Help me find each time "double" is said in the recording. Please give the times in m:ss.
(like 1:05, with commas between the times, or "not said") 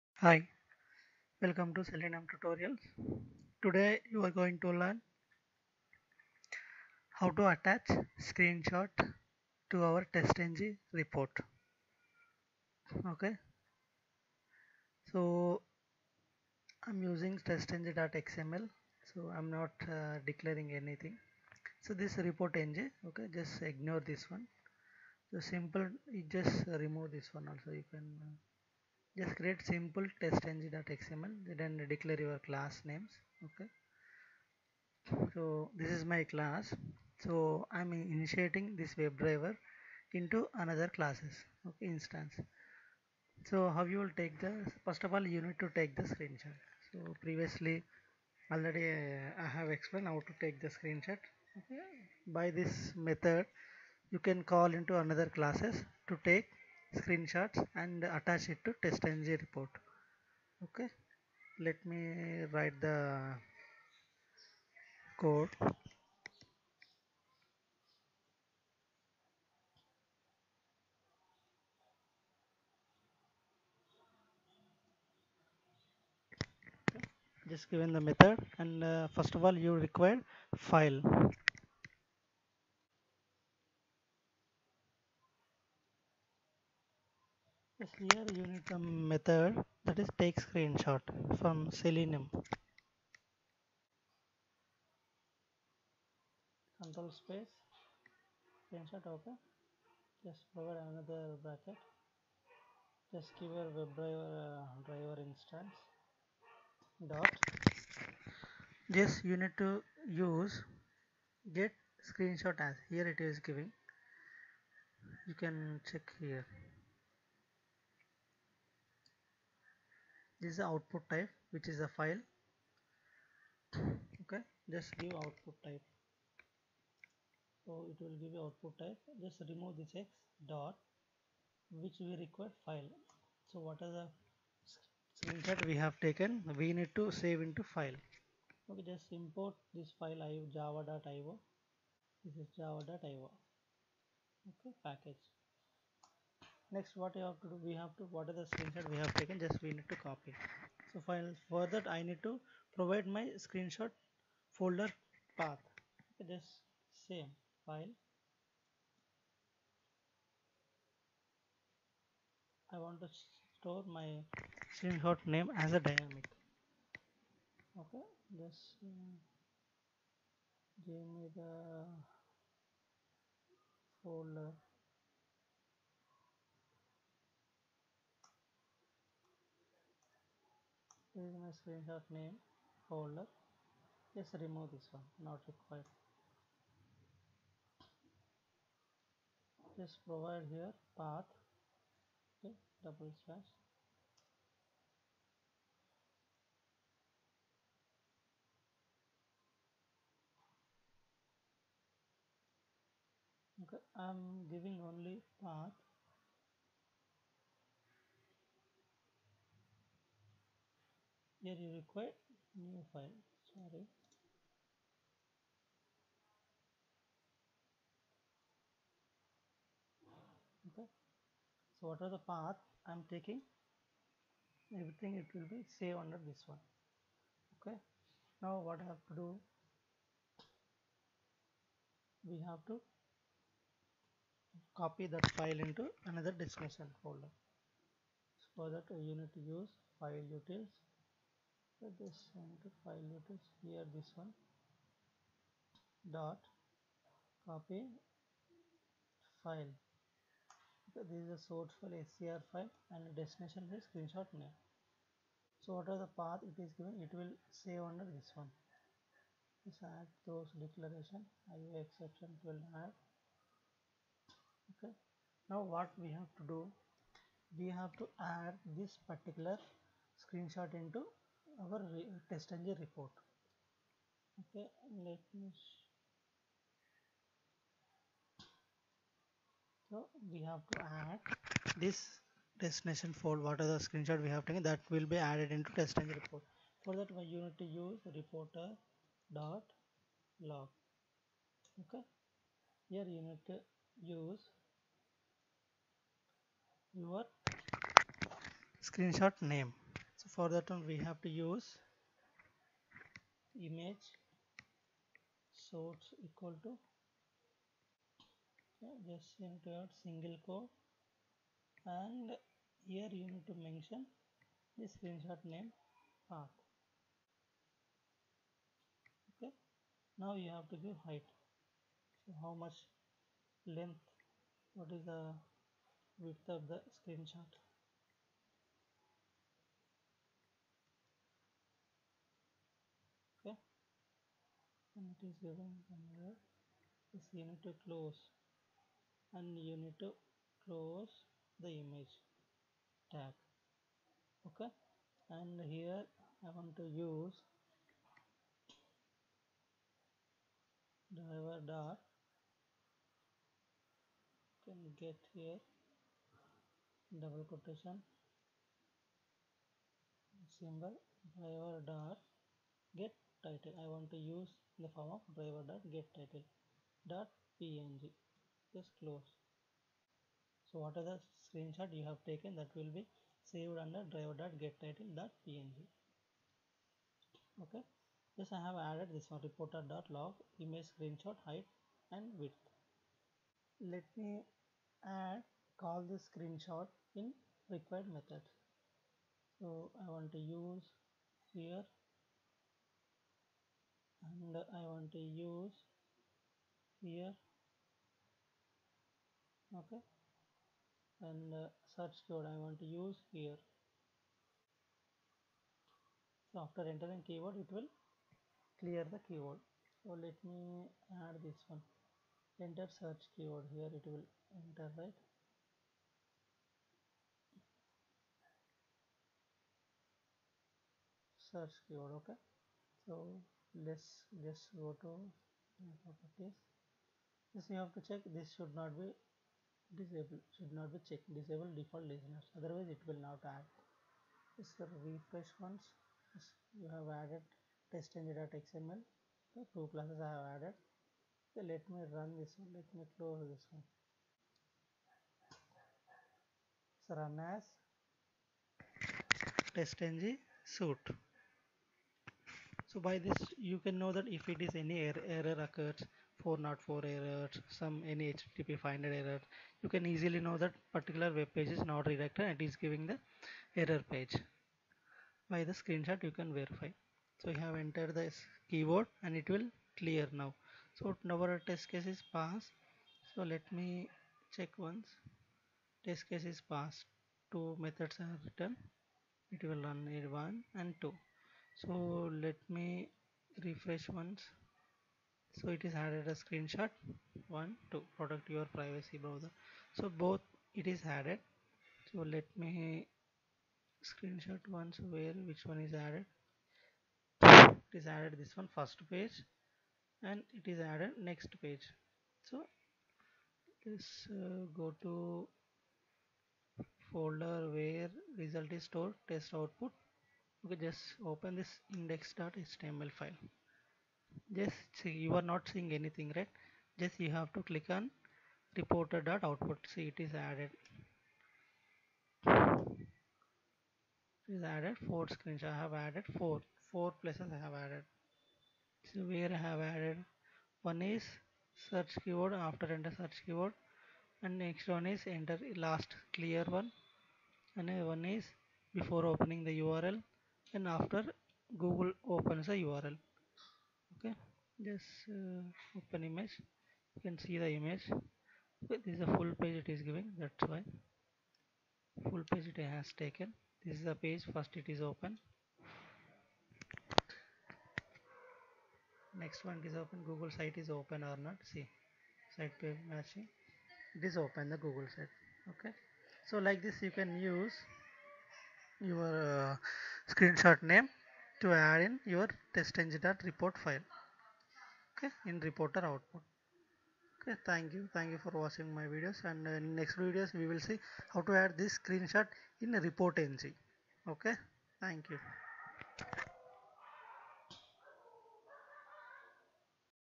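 3:12, 5:57.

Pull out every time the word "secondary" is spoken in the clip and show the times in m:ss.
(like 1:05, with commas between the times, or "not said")
not said.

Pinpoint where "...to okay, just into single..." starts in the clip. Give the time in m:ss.
5:06.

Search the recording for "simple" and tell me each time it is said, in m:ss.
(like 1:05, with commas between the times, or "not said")
0:25, 0:29.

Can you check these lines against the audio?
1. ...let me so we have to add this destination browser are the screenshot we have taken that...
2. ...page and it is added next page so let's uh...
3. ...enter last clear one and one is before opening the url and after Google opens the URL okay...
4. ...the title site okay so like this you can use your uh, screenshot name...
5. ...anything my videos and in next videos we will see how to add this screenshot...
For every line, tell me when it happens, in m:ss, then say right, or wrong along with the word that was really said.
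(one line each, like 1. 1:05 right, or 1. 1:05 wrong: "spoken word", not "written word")
1. 4:35 wrong: "folder", not "browser"
2. 8:19 right
3. 8:55 right
4. 9:24 wrong: "google", not "title"
5. 9:38 wrong: "watching", not "anything".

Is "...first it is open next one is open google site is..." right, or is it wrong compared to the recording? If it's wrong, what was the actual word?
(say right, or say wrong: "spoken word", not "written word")
right.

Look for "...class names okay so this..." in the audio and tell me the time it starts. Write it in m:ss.
0:32.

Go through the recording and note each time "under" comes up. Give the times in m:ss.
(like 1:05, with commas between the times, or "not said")
3:46, 4:17, 6:13.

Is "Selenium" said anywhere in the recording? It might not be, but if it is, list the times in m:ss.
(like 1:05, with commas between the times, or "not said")
0:01, 1:31.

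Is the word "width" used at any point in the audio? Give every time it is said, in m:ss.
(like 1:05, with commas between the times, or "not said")
5:26, 6:22.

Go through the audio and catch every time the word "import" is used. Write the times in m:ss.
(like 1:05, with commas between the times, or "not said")
2:19.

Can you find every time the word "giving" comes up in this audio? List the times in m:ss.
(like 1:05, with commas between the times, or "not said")
1:53, 3:24, 7:42, 9:10.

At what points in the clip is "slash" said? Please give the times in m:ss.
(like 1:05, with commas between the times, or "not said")
3:13.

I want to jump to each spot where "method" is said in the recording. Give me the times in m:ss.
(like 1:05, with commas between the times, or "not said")
0:52, 1:18, 1:28, 6:28, 7:57.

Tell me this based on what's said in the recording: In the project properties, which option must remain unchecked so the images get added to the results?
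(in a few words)
disable default listeners.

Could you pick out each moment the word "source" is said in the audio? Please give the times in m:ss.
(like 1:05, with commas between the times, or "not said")
4:11, 5:05.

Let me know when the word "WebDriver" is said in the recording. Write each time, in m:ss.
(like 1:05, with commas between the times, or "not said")
0:38, 1:43.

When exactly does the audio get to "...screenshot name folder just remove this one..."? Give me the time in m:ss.
3:01.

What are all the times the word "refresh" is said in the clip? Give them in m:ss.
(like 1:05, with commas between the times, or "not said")
7:15, 8:03.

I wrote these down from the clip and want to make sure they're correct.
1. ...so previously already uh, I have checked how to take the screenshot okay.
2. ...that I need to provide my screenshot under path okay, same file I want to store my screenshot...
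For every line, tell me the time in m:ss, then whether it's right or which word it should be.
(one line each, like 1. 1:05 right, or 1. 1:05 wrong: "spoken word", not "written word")
1. 0:46 wrong: "explained", not "checked"
2. 2:31 wrong: "folder", not "under".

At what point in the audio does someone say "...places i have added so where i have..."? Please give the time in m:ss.
8:47.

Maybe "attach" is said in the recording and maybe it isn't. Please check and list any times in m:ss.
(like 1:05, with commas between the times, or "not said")
0:07, 0:58.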